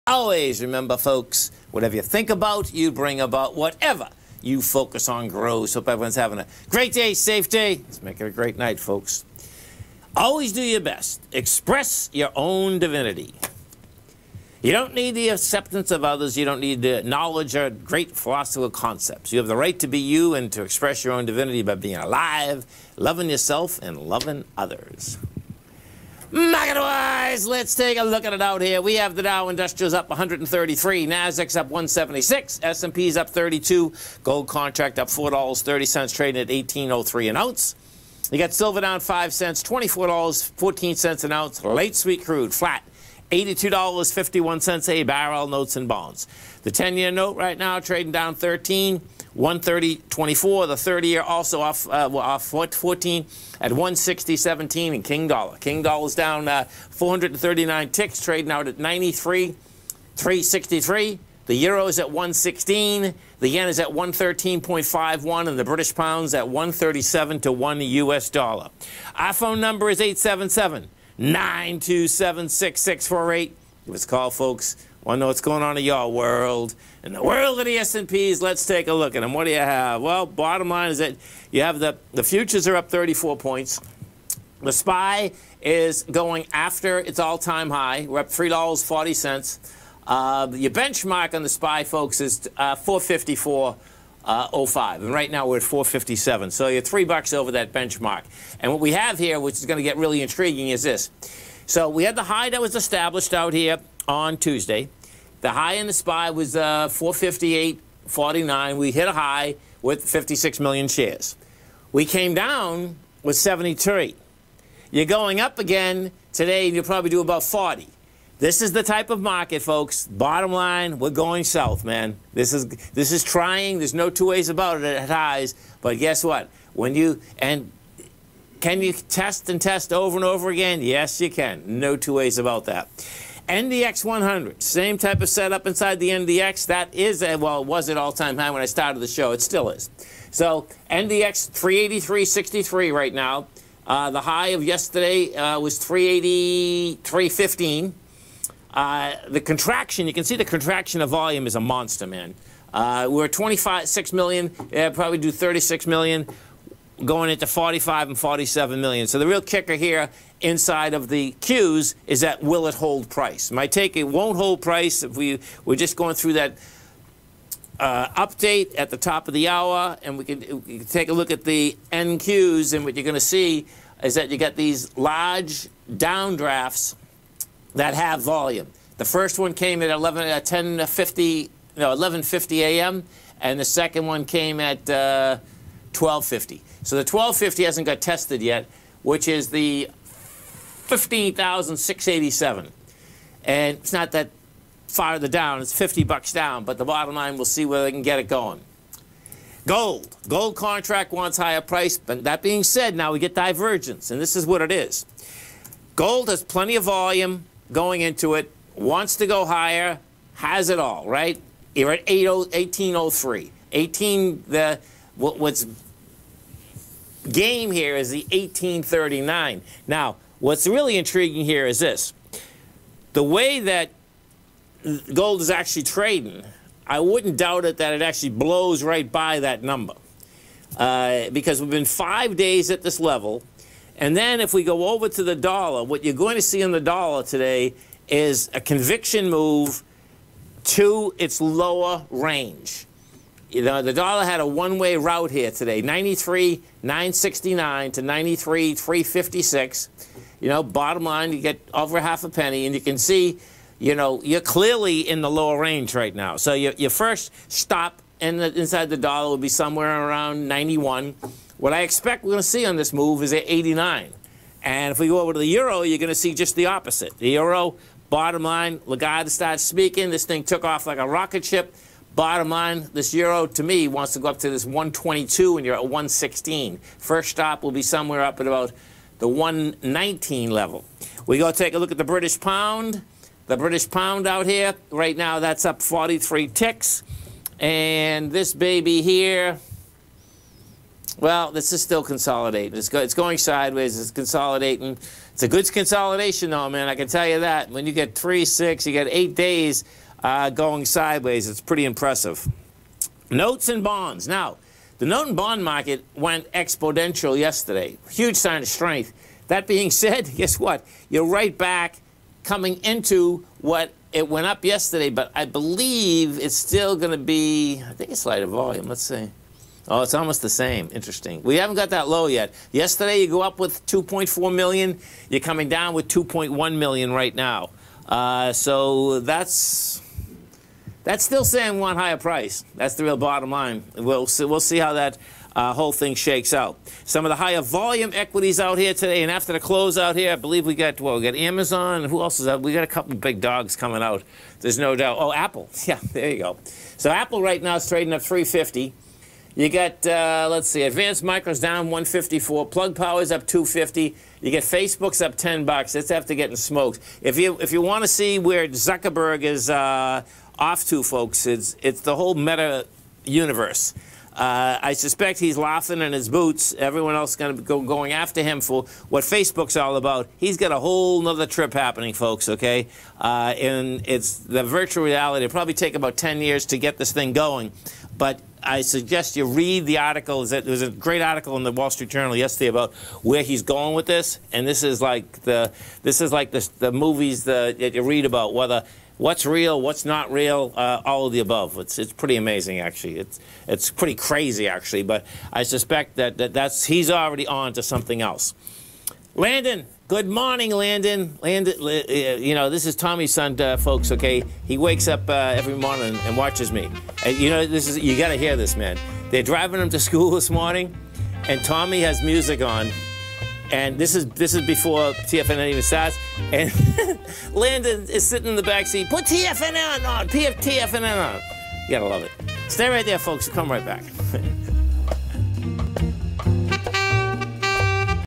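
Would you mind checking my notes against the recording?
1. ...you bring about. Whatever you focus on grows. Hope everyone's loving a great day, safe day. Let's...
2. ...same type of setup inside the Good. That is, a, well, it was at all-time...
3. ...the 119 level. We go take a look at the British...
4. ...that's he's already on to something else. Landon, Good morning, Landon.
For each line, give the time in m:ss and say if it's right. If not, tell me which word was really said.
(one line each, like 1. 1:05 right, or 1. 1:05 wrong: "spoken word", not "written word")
1. 0:02 wrong: "having", not "loving"
2. 2:14 wrong: "NDX", not "Good"
3. 4:39 right
4. 6:36 right.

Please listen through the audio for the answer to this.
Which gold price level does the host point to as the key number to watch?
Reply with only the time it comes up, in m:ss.
3:38.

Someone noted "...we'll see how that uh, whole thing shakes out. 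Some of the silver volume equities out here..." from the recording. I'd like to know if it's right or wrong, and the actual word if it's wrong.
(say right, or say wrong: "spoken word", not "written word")
wrong: "higher", not "silver".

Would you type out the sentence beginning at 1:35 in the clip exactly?
And right now we're at 457.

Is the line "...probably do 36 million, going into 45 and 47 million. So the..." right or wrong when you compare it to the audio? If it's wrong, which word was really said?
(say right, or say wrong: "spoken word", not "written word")
right.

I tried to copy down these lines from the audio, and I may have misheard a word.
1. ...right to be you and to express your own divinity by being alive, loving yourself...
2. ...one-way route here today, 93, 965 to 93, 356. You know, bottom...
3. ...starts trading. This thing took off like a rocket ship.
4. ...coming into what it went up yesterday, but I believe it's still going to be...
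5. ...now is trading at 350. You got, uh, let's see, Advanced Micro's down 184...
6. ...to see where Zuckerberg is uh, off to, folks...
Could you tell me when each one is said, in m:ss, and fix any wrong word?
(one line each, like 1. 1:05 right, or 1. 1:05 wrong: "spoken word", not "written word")
1. 0:19 right
2. 4:04 wrong: "969", not "965"
3. 4:29 wrong: "speaking", not "trading"
4. 5:12 right
5. 5:47 wrong: "154", not "184"
6. 5:58 right.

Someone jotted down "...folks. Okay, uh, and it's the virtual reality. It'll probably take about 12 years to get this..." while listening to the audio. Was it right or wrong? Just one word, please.
wrong.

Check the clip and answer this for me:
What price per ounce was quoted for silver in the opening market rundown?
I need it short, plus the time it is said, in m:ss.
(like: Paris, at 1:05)
$24.14, at 0:39.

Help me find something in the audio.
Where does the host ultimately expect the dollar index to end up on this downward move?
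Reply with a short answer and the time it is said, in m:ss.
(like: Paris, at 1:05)
89, at 4:23.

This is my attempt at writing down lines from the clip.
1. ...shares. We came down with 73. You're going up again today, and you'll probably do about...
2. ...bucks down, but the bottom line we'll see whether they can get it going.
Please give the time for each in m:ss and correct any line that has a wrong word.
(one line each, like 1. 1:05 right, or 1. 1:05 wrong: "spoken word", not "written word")
1. 1:50 right
2. 3:16 right.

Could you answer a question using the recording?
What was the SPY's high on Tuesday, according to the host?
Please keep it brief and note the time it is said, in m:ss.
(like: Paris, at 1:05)
458.49, at 1:46.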